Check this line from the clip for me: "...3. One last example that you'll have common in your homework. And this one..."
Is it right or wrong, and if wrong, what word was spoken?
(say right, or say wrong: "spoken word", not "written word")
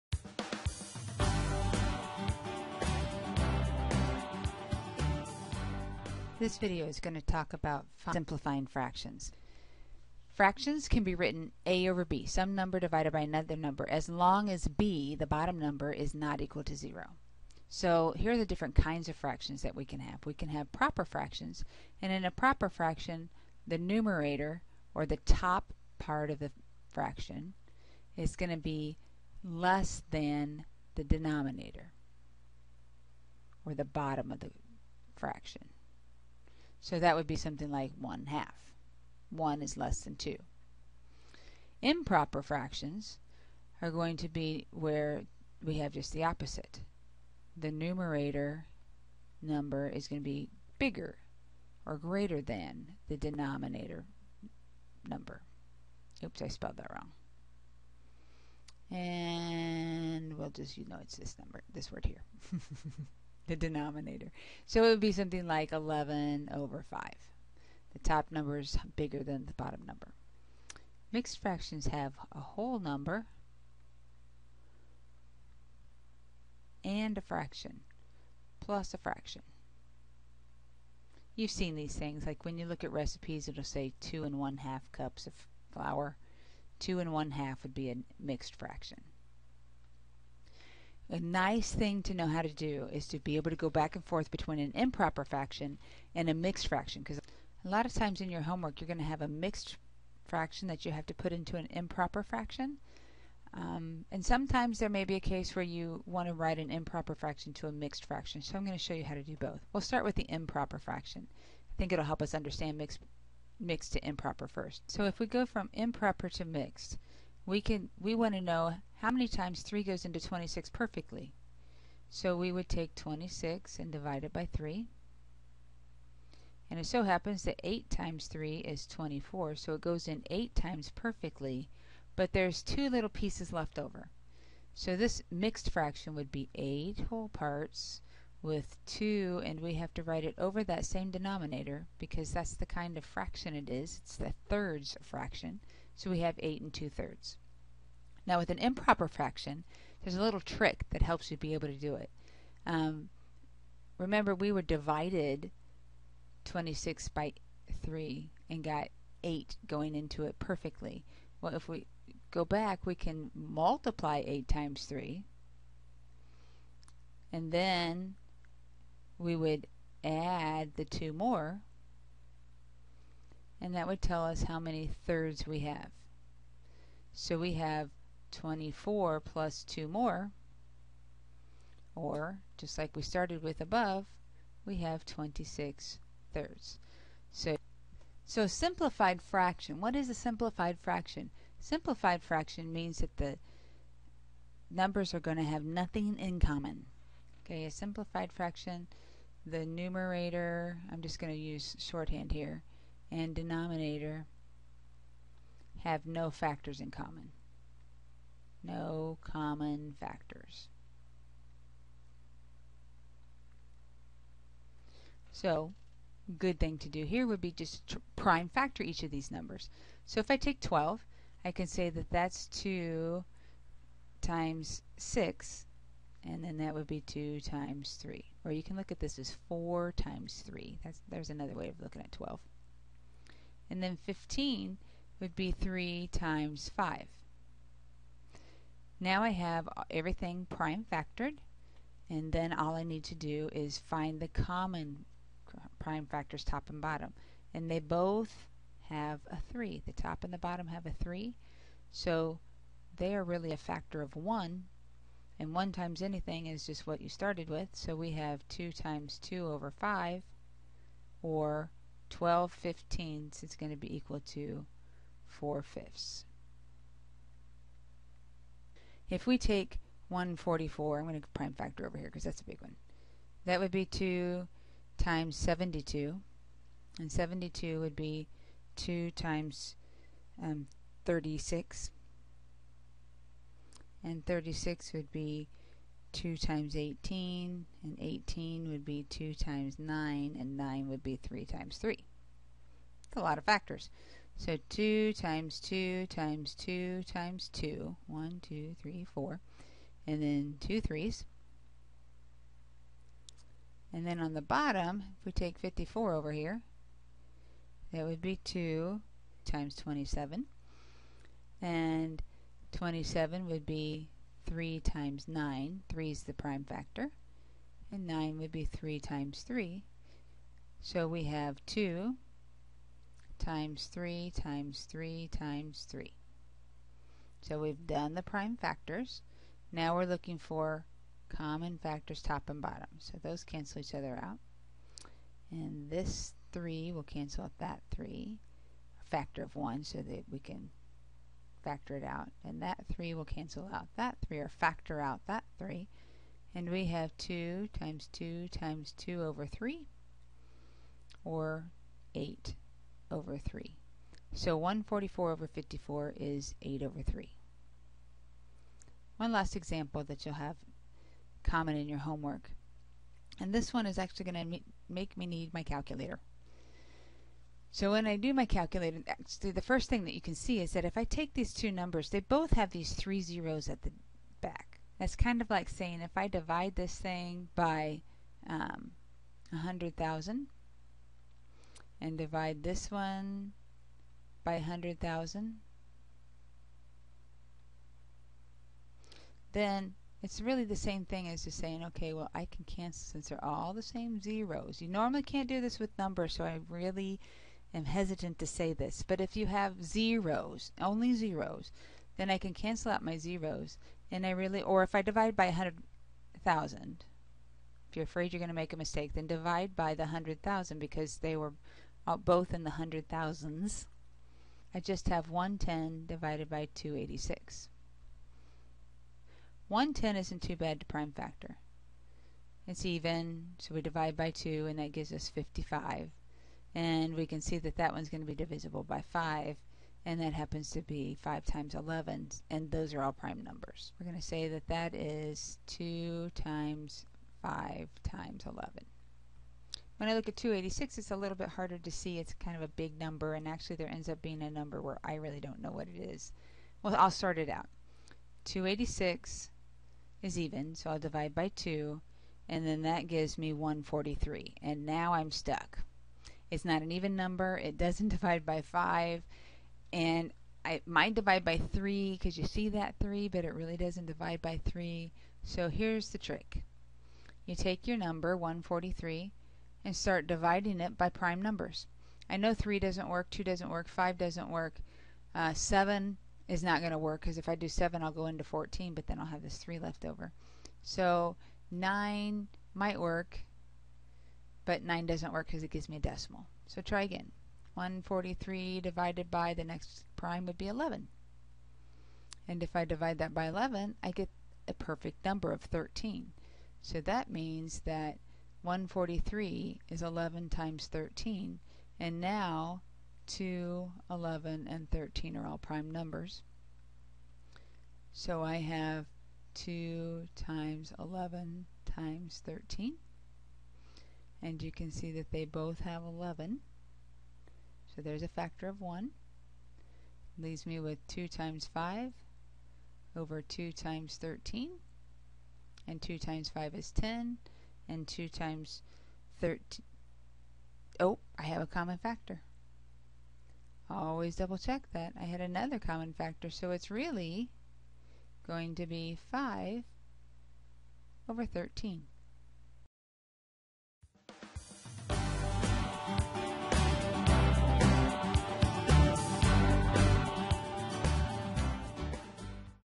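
right.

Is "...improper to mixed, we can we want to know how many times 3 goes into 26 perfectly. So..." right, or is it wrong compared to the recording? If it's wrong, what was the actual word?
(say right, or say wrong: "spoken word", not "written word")
right.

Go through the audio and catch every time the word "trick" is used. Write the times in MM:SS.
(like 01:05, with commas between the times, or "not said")
02:30, 07:46.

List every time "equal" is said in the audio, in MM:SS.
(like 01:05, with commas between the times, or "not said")
00:16, 04:23.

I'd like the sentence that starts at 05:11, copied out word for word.
And 27 would be 3 times 9.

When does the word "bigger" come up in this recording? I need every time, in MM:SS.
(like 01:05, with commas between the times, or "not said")
00:50, 01:08.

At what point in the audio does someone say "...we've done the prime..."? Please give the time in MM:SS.
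05:27.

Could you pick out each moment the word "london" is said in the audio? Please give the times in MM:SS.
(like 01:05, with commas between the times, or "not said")
not said.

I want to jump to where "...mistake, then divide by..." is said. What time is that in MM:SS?
06:48.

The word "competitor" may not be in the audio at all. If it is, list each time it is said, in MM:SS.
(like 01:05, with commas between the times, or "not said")
not said.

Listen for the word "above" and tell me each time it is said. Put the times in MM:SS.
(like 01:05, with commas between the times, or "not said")
03:03.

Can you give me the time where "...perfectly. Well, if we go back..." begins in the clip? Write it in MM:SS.
02:40.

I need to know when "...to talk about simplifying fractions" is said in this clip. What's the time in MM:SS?
00:07.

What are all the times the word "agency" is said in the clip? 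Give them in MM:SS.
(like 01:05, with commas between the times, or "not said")
not said.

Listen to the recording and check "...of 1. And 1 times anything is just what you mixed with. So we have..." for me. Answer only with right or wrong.
wrong.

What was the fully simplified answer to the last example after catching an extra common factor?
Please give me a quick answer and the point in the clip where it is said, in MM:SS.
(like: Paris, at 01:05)
5/13, at 08:59.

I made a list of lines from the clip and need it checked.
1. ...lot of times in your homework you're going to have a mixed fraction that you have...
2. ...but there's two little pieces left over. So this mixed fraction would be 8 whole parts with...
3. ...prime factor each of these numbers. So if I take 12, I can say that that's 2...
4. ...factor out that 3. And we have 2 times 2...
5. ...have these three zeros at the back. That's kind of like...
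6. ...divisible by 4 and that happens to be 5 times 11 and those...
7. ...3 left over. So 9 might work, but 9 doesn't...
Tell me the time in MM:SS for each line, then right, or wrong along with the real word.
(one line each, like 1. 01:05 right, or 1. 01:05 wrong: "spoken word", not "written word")
1. 01:37 right
2. 02:12 right
3. 03:38 right
4. 05:44 right
5. 06:12 right
6. 07:08 wrong: "5", not "4"
7. 07:59 right.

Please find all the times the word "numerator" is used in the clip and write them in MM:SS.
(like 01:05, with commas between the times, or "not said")
00:23, 00:47, 03:19.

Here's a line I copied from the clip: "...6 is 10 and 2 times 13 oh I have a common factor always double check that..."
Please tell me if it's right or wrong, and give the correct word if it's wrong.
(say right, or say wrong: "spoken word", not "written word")
wrong: "5", not "6".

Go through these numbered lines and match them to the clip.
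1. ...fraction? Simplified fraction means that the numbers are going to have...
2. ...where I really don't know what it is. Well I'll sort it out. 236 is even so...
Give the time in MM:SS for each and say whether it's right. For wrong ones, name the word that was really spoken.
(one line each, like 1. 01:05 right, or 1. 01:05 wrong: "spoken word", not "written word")
1. 03:10 right
2. 07:24 wrong: "286", not "236".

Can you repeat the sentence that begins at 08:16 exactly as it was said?
So that means that 143 is 11 times 13.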